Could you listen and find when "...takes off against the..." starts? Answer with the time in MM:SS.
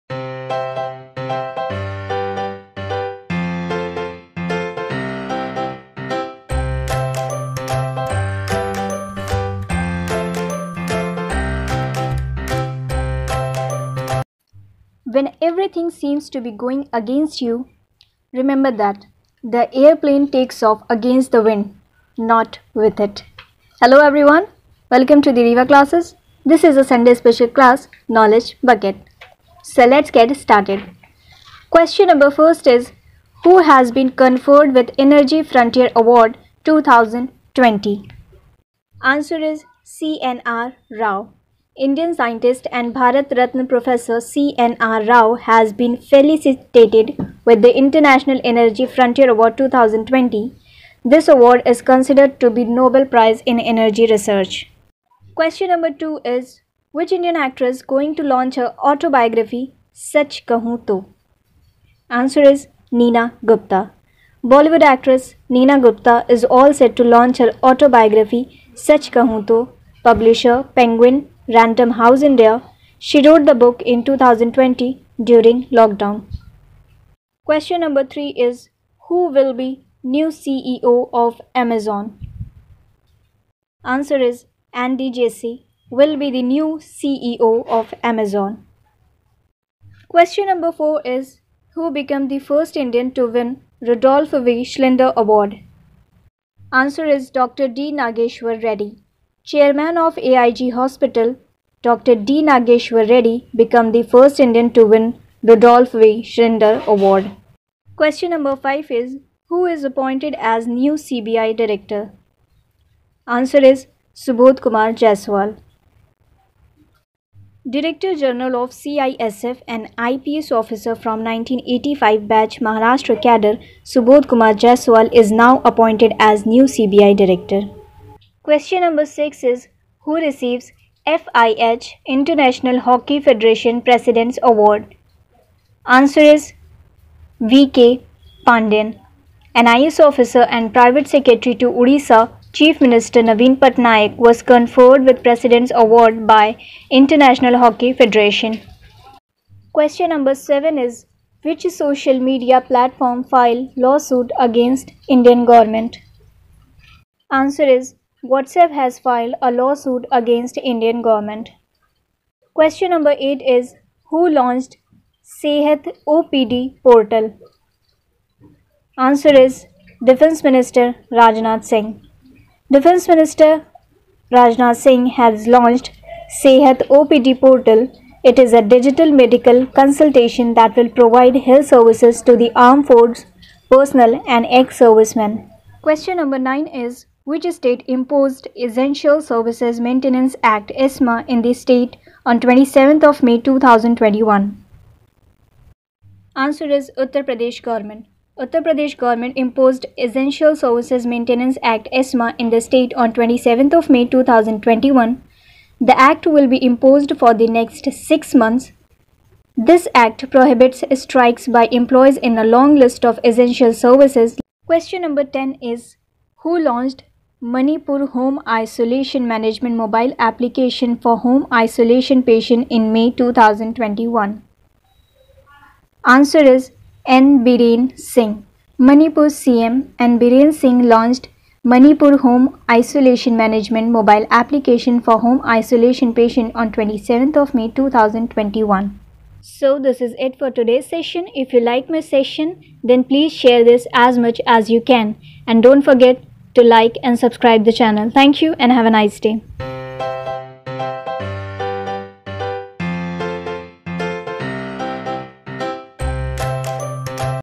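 00:20.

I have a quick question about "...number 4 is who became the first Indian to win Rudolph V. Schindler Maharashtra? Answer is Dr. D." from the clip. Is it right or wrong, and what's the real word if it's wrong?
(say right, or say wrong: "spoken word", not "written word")
wrong: "Award", not "Maharashtra".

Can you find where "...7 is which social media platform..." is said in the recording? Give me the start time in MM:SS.
02:30.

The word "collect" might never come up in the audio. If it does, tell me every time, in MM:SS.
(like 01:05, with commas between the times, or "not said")
not said.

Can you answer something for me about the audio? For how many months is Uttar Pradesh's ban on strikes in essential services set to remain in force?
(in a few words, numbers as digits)
6.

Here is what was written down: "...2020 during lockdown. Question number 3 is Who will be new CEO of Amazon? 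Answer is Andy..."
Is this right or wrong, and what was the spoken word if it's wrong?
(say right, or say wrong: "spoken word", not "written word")
right.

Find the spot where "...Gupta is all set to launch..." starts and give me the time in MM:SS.
01:05.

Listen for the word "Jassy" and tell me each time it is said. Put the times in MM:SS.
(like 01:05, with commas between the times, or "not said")
01:25.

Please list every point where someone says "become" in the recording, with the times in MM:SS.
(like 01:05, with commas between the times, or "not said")
01:43.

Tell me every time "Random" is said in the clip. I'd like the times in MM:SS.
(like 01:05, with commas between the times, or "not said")
01:11.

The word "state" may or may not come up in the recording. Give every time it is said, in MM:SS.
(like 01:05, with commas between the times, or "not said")
03:07, 03:11, 03:22.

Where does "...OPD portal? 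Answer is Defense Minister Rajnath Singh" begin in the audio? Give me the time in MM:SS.
02:46.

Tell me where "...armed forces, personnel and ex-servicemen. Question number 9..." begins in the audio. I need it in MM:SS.
03:02.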